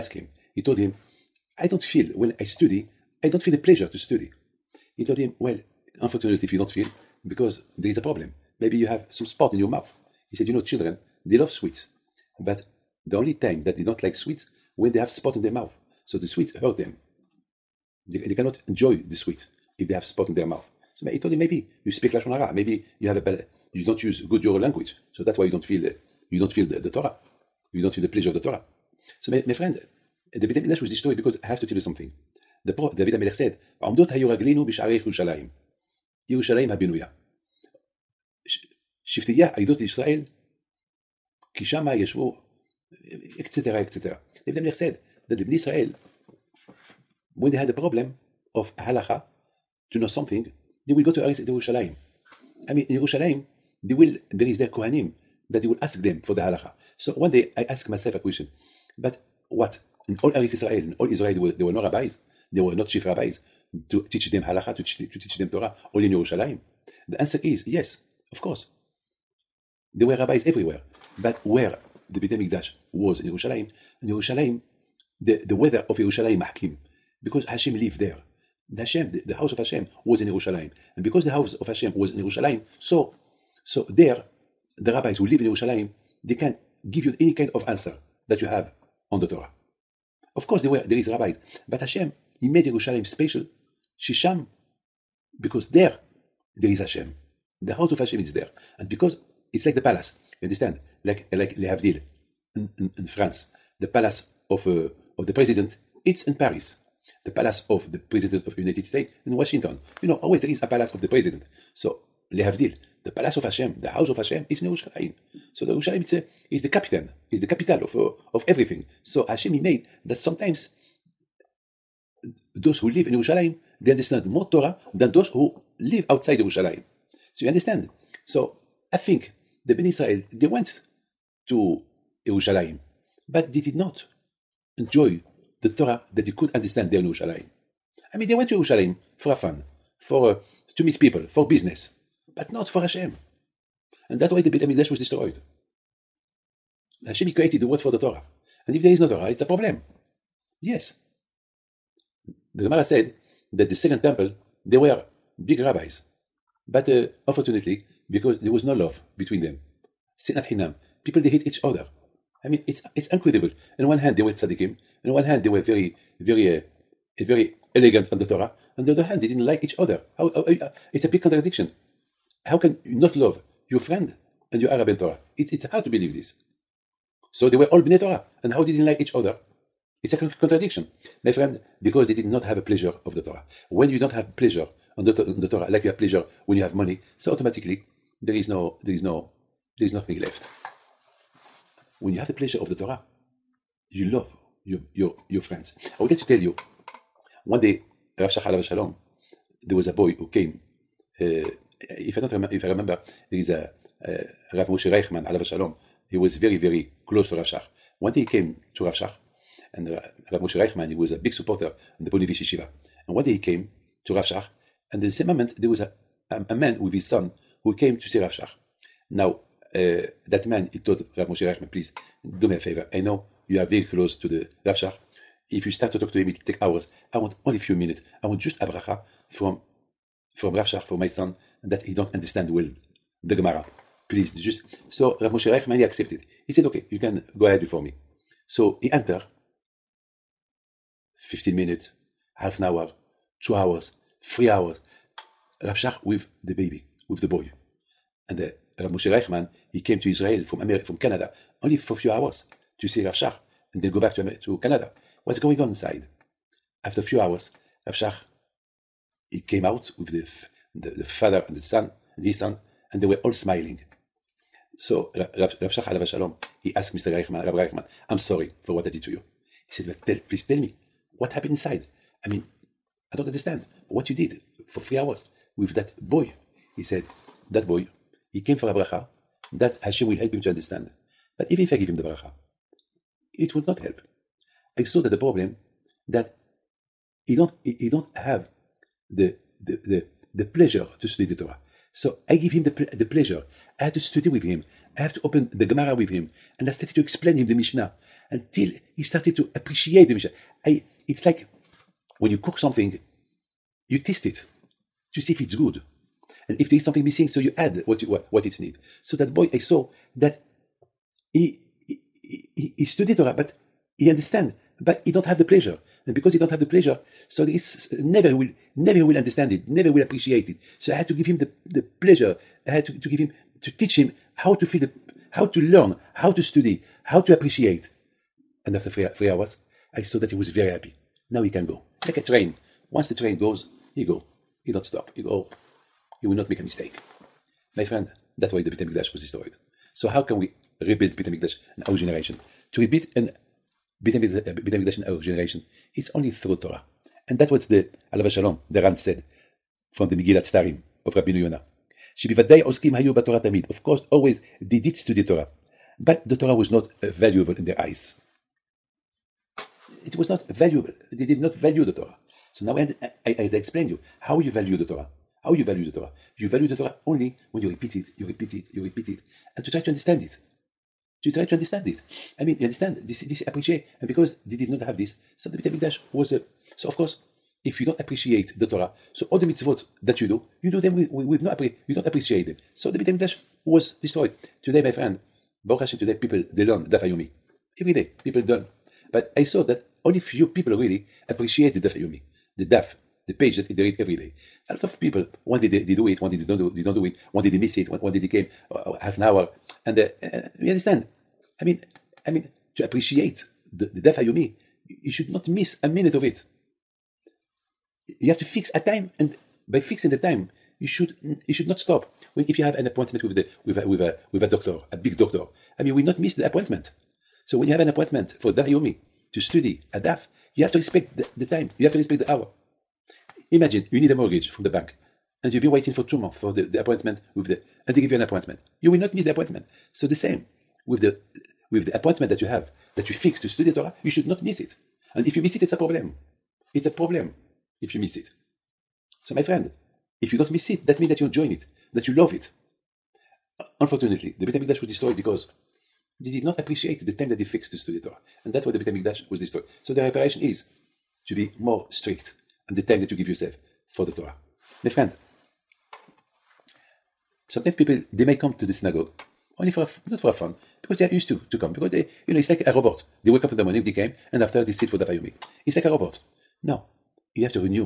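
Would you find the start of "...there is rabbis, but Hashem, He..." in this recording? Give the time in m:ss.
1:30.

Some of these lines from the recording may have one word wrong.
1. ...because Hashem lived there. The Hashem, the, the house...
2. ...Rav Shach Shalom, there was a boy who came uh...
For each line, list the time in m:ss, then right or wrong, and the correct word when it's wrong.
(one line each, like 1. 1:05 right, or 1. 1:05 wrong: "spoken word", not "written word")
1. 1:17 right
2. 3:18 right.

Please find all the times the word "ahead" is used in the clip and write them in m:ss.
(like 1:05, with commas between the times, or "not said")
3:57.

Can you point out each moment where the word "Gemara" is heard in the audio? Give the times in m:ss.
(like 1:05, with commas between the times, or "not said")
2:32, 3:53, 4:55.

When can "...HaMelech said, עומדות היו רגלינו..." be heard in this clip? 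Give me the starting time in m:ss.
0:33.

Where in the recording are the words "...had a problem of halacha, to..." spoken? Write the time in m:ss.
0:47.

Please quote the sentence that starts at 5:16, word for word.
And because he don't have the pleasure, so there is never will, never will understand it, never will appreciate it.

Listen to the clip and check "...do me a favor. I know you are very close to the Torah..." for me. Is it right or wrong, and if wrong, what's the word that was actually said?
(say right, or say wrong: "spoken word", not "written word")
wrong: "Rav", not "Torah".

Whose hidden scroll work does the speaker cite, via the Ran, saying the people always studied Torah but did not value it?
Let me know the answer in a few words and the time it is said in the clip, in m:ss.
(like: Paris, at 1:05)
Rabbi Yonah, at 5:51.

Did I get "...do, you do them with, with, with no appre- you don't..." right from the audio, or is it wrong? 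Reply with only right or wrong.
right.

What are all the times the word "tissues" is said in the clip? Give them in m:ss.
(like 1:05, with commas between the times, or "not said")
not said.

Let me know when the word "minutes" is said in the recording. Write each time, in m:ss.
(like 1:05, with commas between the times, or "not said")
3:47, 4:01, 6:45.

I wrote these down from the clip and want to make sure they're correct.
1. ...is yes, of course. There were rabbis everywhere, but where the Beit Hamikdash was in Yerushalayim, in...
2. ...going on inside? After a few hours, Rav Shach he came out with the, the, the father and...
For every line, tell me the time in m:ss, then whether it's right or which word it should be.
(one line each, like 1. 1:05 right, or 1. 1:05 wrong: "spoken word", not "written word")
1. 1:07 right
2. 4:15 right.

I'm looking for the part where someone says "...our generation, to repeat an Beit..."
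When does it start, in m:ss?
5:41.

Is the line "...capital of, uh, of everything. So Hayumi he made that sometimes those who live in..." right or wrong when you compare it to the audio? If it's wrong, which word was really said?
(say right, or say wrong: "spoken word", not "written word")
wrong: "Hashem", not "Hayumi".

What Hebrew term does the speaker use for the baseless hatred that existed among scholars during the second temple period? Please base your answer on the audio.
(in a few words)
Sinat Hinam.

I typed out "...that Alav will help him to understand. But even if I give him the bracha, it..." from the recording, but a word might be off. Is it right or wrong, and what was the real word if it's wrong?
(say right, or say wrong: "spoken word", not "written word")
wrong: "Hashem", not "Alav".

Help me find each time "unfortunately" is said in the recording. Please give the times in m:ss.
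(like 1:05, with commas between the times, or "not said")
0:06, 2:37, 7:23.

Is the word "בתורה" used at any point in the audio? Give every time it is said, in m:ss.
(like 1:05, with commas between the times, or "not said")
5:53.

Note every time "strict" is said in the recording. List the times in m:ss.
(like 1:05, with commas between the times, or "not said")
7:31.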